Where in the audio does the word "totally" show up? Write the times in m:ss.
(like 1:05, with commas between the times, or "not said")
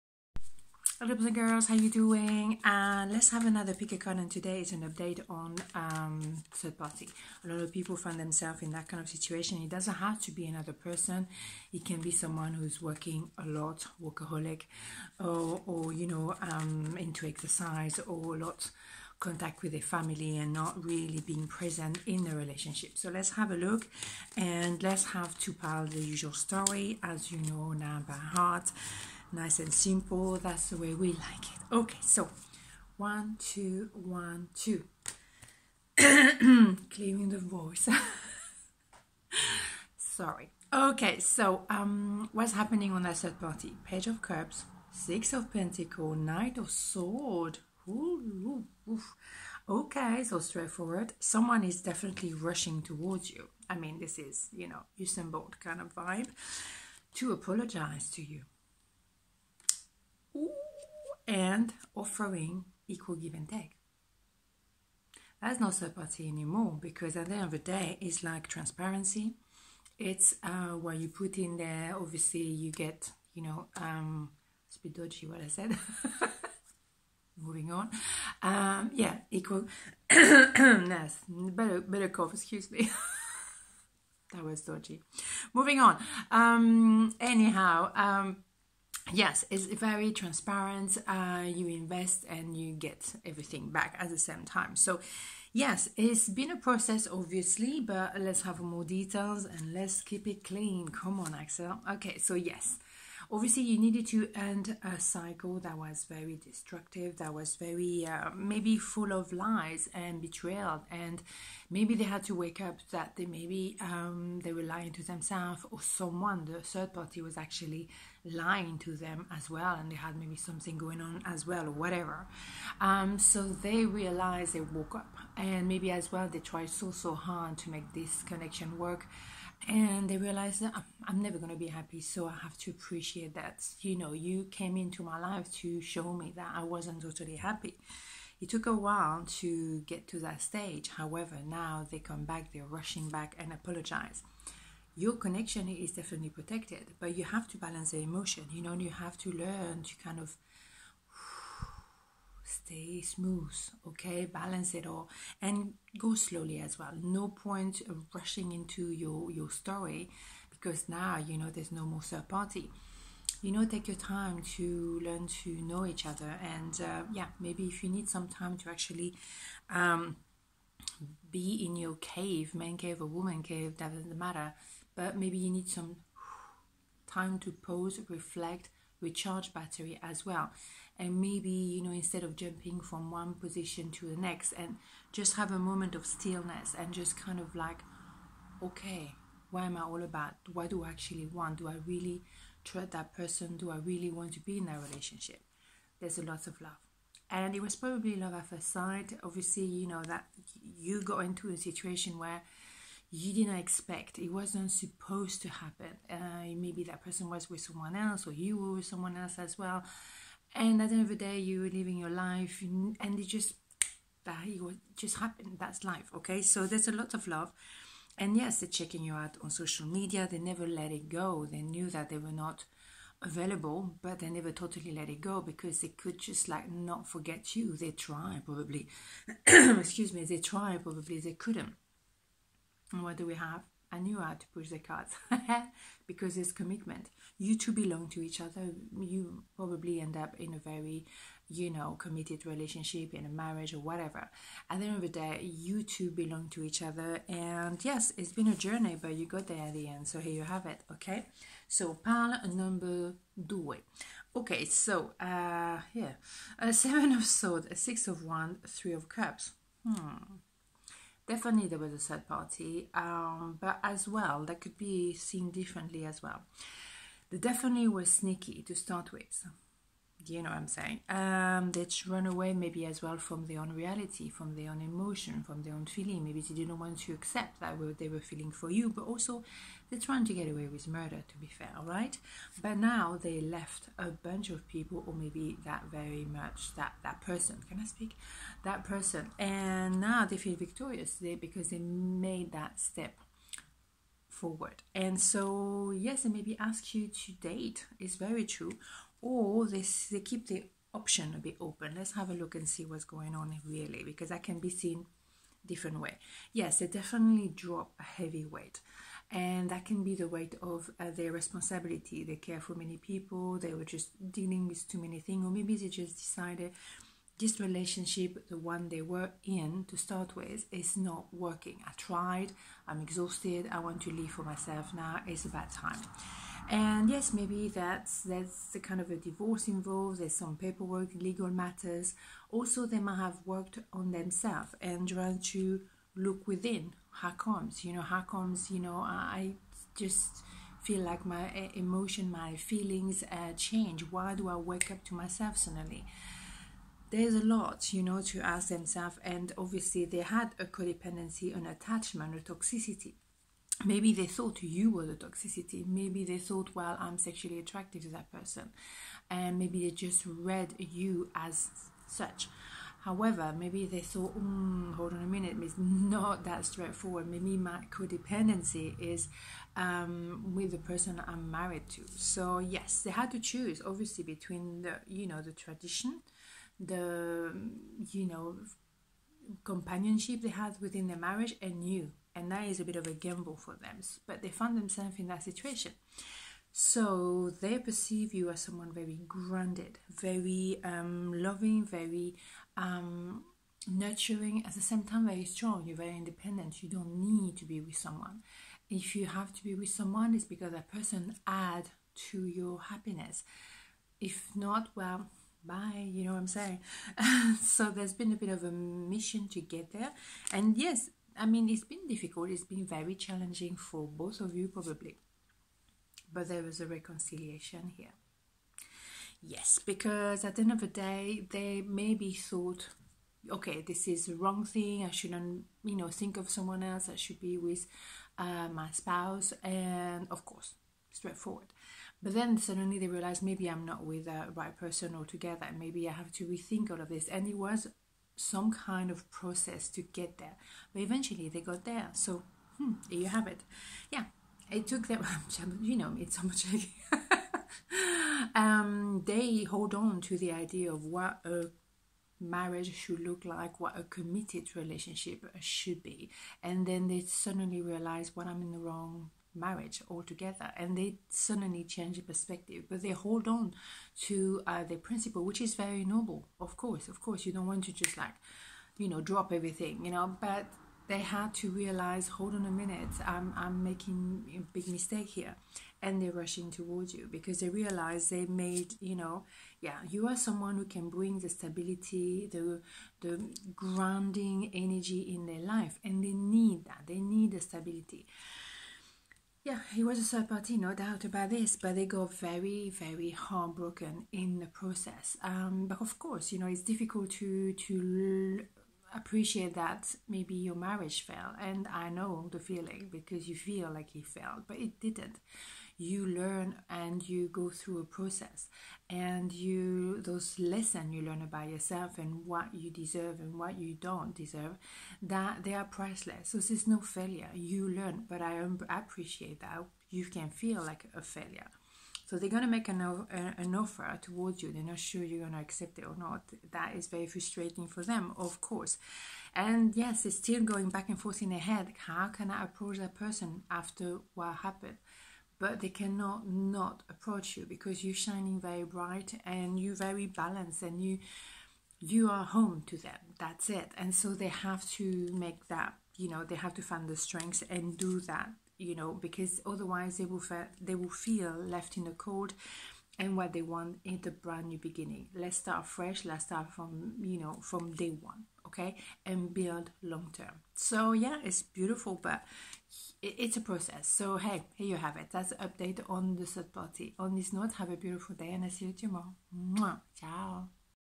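2:17, 3:44.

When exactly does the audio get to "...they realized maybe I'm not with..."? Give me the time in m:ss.
7:12.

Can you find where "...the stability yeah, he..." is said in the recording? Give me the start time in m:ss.
8:07.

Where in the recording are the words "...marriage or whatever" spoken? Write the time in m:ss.
4:03.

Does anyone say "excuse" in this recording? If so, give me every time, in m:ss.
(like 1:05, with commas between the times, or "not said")
1:22, 3:49.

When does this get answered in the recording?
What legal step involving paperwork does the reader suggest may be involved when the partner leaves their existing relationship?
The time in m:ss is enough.
5:29.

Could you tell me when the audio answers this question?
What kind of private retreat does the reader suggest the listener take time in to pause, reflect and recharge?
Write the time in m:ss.
2:52.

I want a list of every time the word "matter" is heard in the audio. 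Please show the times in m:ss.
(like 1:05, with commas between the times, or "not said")
2:54, 5:31.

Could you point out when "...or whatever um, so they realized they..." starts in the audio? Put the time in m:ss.
2:01.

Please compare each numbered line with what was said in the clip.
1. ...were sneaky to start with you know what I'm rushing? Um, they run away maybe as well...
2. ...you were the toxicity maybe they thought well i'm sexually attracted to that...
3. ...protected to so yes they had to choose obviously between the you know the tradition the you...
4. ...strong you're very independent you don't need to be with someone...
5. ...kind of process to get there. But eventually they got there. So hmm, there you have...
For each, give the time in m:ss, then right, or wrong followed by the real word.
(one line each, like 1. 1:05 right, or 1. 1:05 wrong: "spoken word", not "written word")
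1. 4:27 wrong: "saying", not "rushing"
2. 5:54 right
3. 6:11 wrong: "married", not "protected"
4. 6:35 right
5. 7:18 right.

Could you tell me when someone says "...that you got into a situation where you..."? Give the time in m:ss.
3:20.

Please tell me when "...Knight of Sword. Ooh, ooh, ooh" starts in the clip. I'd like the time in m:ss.
0:46.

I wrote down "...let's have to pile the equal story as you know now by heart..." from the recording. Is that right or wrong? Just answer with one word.
wrong.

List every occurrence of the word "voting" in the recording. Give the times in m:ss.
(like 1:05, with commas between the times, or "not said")
not said.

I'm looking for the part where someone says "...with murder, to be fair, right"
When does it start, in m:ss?
4:40.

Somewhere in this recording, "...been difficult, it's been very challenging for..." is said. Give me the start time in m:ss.
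6:51.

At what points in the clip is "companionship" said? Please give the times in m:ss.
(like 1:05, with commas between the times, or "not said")
6:19.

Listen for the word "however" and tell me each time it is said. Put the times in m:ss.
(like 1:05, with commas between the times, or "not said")
2:20, 6:03.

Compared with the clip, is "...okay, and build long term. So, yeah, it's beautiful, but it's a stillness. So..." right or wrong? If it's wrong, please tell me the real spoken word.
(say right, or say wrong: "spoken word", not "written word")
wrong: "process", not "stillness".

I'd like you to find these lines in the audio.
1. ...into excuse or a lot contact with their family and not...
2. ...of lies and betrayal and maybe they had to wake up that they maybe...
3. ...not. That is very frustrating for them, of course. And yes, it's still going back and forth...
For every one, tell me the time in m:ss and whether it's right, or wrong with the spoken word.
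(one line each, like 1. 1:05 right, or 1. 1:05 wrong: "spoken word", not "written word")
1. 0:16 wrong: "exercise", not "excuse"
2. 1:49 right
3. 8:46 right.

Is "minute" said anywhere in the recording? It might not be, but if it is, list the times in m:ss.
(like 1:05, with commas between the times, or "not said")
6:05, 7:52.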